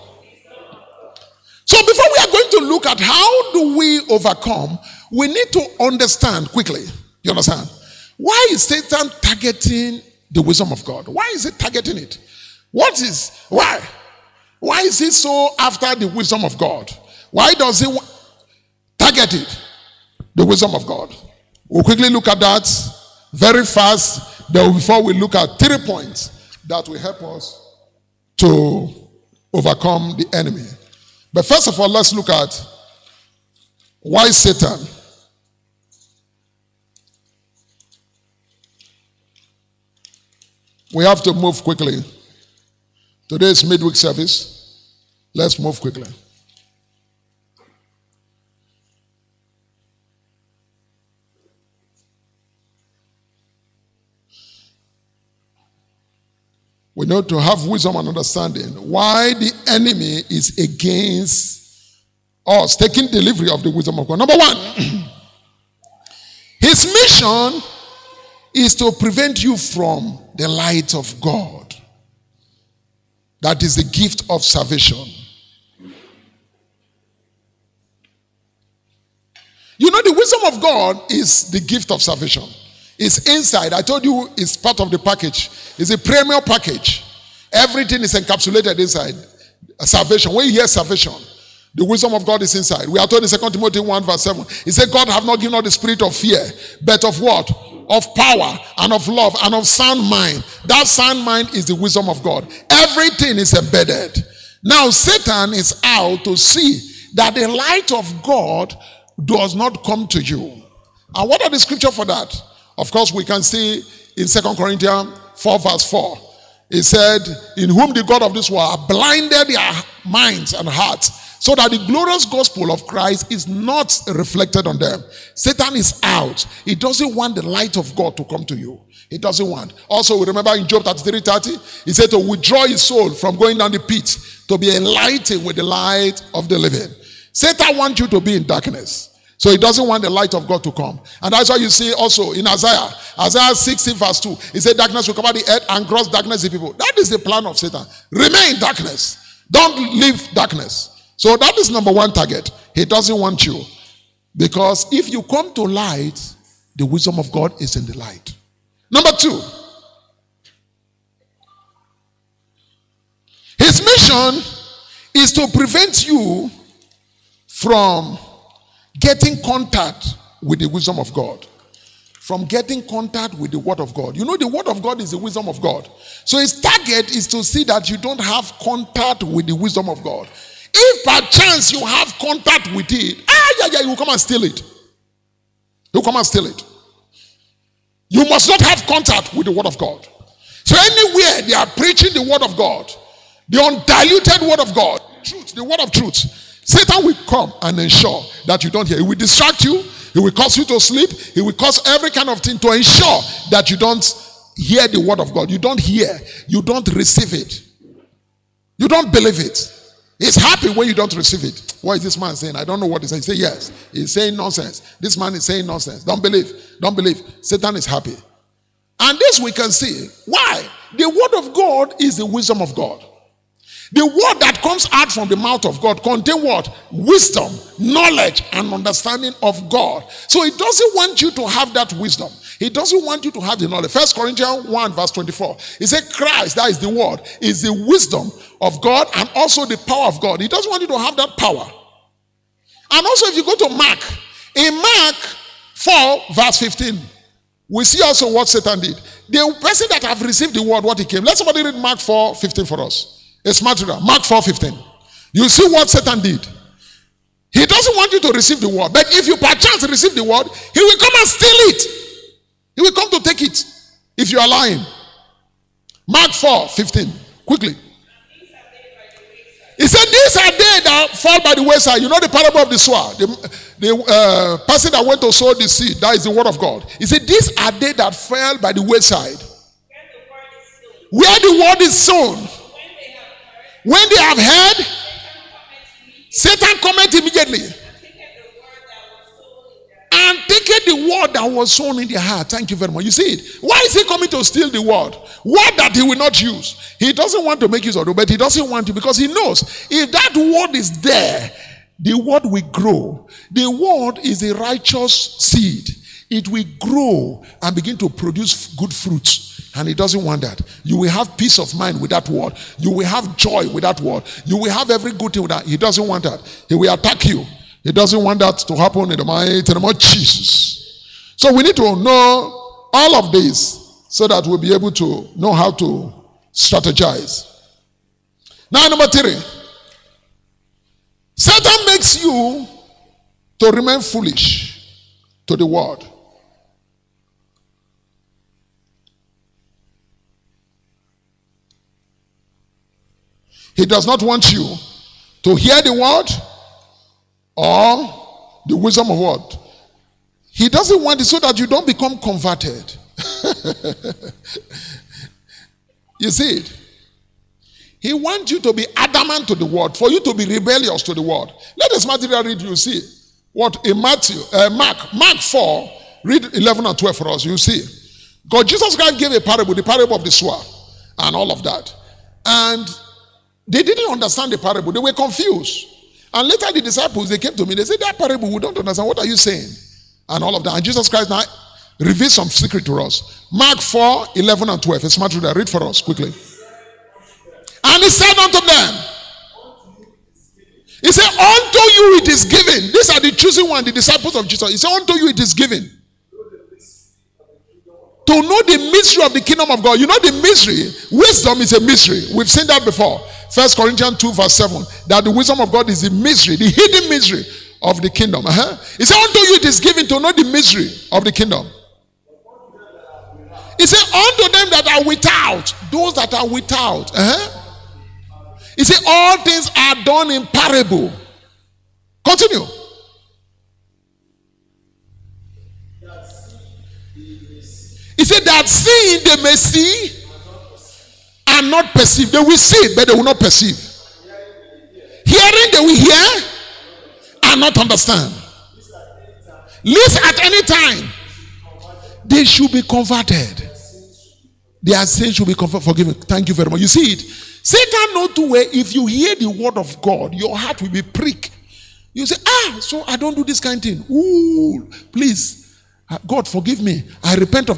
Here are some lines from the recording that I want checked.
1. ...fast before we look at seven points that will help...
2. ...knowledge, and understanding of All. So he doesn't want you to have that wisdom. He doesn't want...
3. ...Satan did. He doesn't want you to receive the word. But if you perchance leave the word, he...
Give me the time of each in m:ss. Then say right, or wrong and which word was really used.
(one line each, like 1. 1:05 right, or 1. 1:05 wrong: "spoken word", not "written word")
1. 0:23 wrong: "three", not "seven"
2. 3:47 wrong: "God", not "All"
3. 4:15 wrong: "receive", not "leave".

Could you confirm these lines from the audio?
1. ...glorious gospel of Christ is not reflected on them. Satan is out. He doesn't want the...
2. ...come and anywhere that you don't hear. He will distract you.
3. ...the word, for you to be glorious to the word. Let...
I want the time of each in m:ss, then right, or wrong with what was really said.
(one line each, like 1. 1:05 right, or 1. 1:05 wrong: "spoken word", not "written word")
1. 2:01 right
2. 3:17 wrong: "ensure", not "anywhere"
3. 5:59 wrong: "rebellious", not "glorious".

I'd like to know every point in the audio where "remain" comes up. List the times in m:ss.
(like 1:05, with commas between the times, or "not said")
2:28, 5:33.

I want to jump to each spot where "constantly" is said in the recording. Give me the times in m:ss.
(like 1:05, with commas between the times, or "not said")
not said.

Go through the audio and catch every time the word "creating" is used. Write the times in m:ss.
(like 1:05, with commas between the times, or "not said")
not said.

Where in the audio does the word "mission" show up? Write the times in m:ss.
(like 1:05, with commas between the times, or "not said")
1:06, 2:43.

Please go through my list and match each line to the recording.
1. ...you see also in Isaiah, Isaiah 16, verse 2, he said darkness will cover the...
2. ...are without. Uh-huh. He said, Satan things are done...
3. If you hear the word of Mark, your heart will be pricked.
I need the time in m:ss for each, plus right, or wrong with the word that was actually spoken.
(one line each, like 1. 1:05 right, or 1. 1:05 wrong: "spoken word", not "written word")
1. 2:21 right
2. 6:56 wrong: "All", not "Satan"
3. 7:28 wrong: "God", not "Mark".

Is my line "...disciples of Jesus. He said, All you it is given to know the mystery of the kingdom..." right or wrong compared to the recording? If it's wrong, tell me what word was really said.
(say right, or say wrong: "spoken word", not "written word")
wrong: "Unto", not "All".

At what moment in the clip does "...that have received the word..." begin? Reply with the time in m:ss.
4:09.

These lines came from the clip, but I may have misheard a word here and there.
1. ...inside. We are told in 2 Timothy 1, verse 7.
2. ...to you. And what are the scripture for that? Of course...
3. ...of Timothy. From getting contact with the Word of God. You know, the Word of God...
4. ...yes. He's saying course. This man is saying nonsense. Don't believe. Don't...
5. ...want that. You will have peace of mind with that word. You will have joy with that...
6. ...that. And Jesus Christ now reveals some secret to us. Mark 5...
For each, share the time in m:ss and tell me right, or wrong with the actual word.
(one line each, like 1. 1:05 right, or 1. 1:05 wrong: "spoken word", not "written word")
1. 1:32 right
2. 1:50 right
3. 2:50 wrong: "God", not "Timothy"
4. 3:33 wrong: "nonsense", not "course"
5. 5:10 right
6. 6:20 wrong: "4", not "5".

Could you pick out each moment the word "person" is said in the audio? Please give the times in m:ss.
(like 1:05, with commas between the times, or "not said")
4:09, 4:34.